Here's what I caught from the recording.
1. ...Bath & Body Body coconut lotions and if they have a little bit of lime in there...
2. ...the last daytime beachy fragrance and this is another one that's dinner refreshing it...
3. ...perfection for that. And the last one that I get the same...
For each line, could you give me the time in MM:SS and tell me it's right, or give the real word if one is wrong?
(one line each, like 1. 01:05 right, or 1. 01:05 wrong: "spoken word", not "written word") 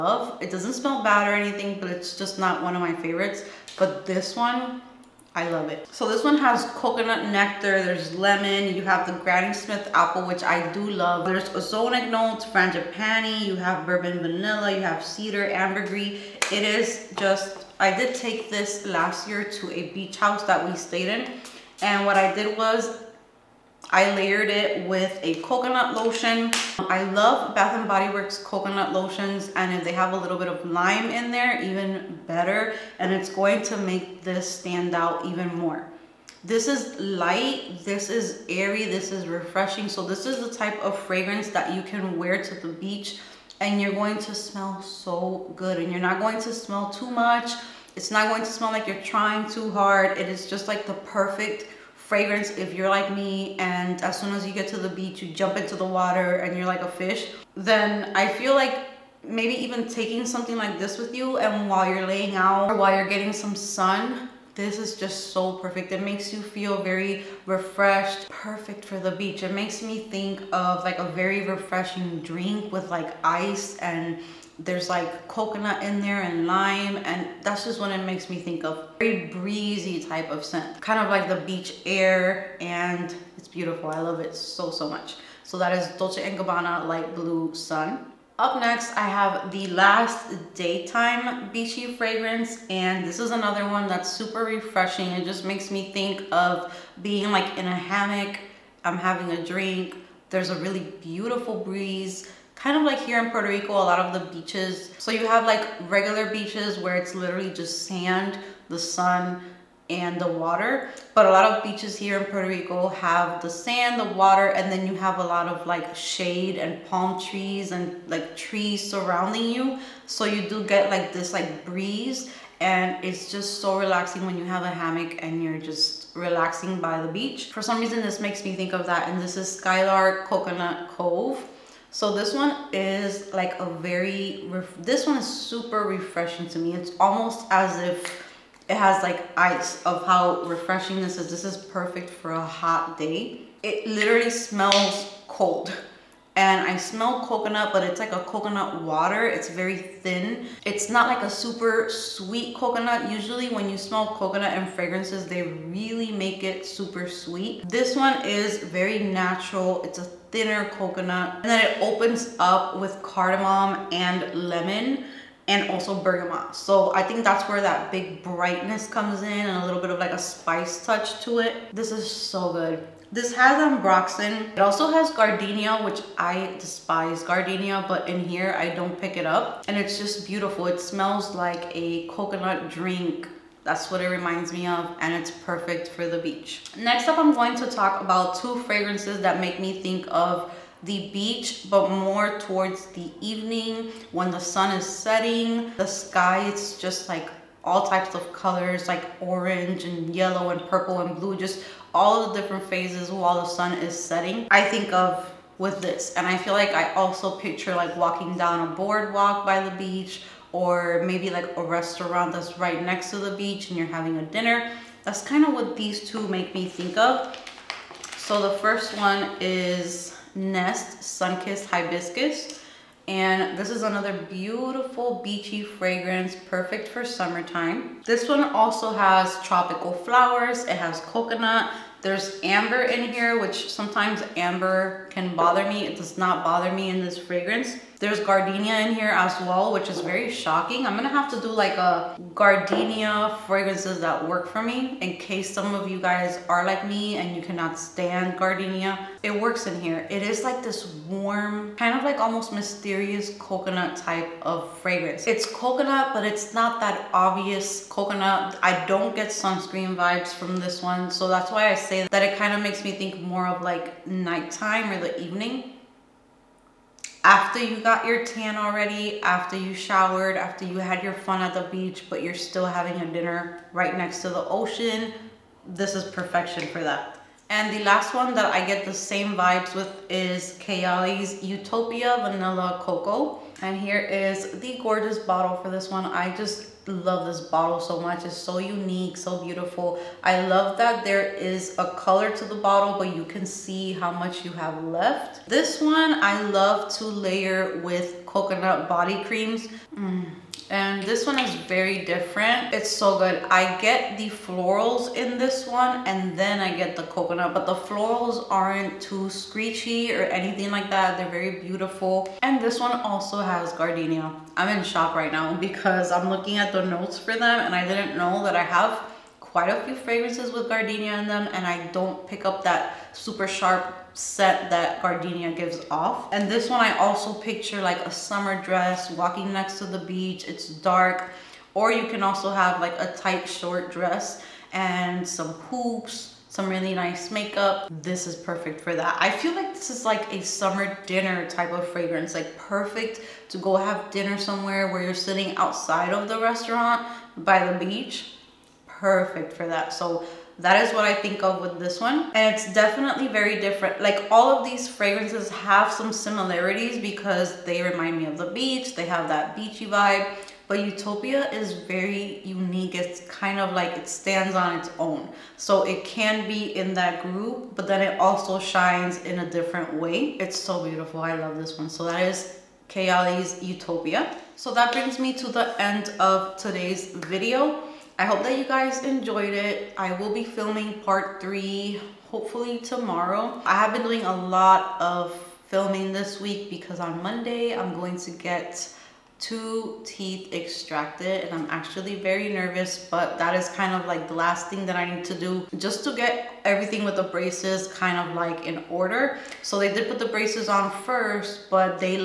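1. 00:27 wrong: "Works", not "Body"
2. 01:29 wrong: "super", not "dinner"
3. 04:36 right.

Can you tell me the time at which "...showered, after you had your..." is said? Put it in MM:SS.
04:29.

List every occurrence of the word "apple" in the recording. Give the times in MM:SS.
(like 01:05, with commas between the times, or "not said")
00:09.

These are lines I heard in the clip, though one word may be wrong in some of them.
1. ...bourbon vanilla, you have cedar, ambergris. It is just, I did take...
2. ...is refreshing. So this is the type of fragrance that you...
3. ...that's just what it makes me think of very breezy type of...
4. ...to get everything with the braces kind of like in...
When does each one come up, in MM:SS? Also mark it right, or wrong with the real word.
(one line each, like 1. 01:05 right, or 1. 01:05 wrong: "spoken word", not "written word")
1. 00:13 right
2. 00:39 right
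3. 01:17 right
4. 06:36 right.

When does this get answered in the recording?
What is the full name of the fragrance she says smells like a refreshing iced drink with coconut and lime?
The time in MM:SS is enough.
01:25.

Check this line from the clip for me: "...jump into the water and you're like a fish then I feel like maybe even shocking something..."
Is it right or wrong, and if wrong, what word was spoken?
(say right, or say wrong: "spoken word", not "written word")
wrong: "taking", not "shocking".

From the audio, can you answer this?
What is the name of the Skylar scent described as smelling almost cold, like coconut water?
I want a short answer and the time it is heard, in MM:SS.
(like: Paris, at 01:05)
Coconut Cove, at 02:10.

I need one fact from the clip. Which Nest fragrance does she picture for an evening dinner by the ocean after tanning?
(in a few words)
Sunkissed Hibiscus.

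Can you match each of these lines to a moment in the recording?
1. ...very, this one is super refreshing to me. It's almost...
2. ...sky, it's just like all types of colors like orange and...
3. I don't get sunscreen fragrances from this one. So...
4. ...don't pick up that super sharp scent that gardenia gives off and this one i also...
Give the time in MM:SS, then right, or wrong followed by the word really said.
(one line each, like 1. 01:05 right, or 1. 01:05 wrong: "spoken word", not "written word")
1. 02:13 right
2. 03:15 right
3. 04:18 wrong: "vibes", not "fragrances"
4. 05:21 right.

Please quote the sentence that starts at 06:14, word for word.
So that brings me to the end of today's video.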